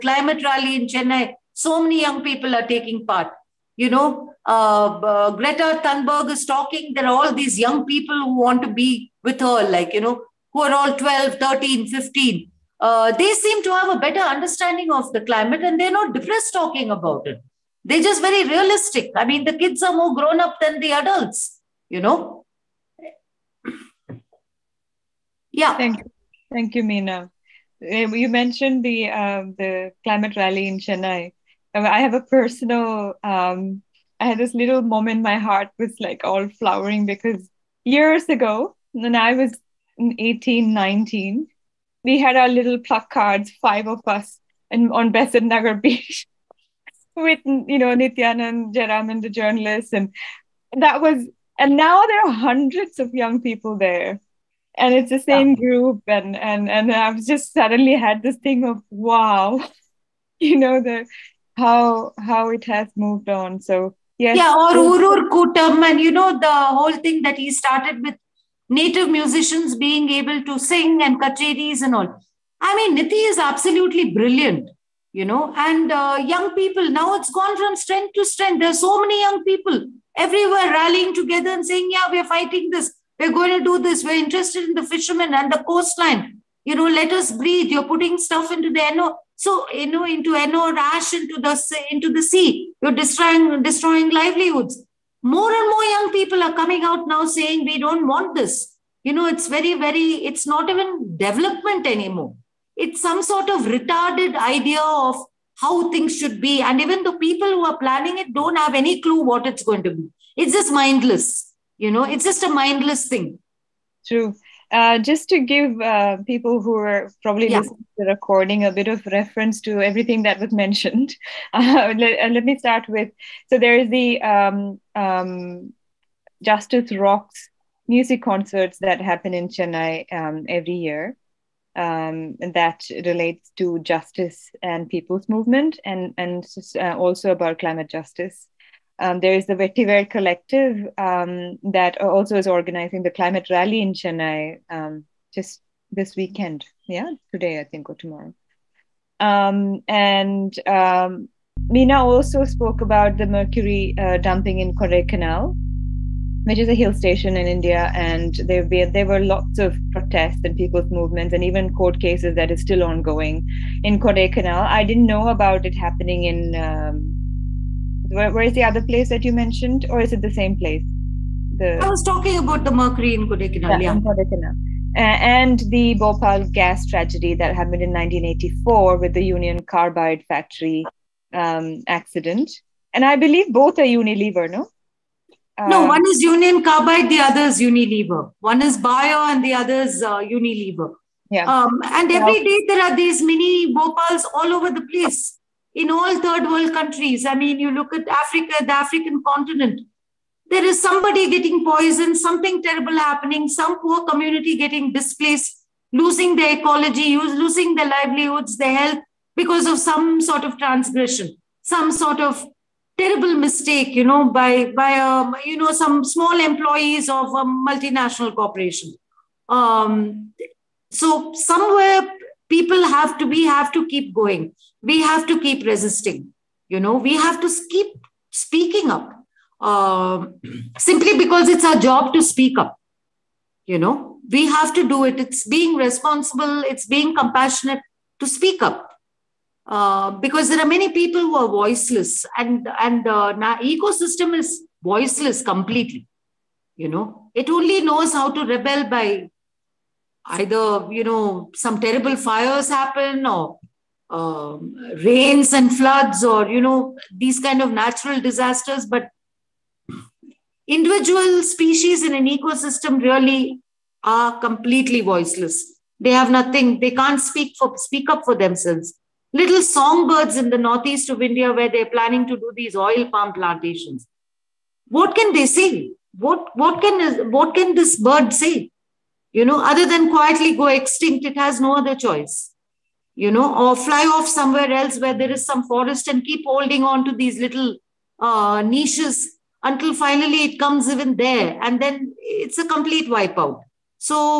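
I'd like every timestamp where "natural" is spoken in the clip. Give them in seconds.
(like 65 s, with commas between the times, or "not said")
257 s.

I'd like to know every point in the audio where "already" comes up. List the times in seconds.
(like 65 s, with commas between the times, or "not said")
not said.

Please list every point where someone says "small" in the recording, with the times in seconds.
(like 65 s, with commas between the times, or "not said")
216 s.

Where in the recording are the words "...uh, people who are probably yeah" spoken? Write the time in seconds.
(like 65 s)
115 s.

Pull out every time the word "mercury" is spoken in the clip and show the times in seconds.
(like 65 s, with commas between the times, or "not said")
153 s, 172 s.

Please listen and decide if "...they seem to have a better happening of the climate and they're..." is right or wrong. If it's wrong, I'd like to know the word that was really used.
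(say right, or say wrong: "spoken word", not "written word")
wrong: "understanding", not "happening".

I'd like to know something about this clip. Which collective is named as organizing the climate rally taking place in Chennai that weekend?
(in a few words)
Vetiver Collective.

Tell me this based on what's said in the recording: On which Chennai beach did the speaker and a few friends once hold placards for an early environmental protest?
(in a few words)
Besant Nagar.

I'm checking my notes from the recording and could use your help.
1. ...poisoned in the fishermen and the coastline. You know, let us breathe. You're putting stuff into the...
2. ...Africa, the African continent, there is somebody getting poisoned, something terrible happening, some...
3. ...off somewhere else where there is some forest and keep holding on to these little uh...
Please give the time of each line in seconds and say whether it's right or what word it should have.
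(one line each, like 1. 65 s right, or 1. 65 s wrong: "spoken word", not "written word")
1. 84 s wrong: "interested", not "poisoned"
2. 198 s right
3. 284 s right.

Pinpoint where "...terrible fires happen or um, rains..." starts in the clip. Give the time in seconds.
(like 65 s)
251 s.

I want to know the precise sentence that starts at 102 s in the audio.
It's some sort of retarded idea of how things should be.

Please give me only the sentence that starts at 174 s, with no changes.
Uh, and the Bhopal gas tragedy that happened in 1984 with the Union Carbide factory um, accident.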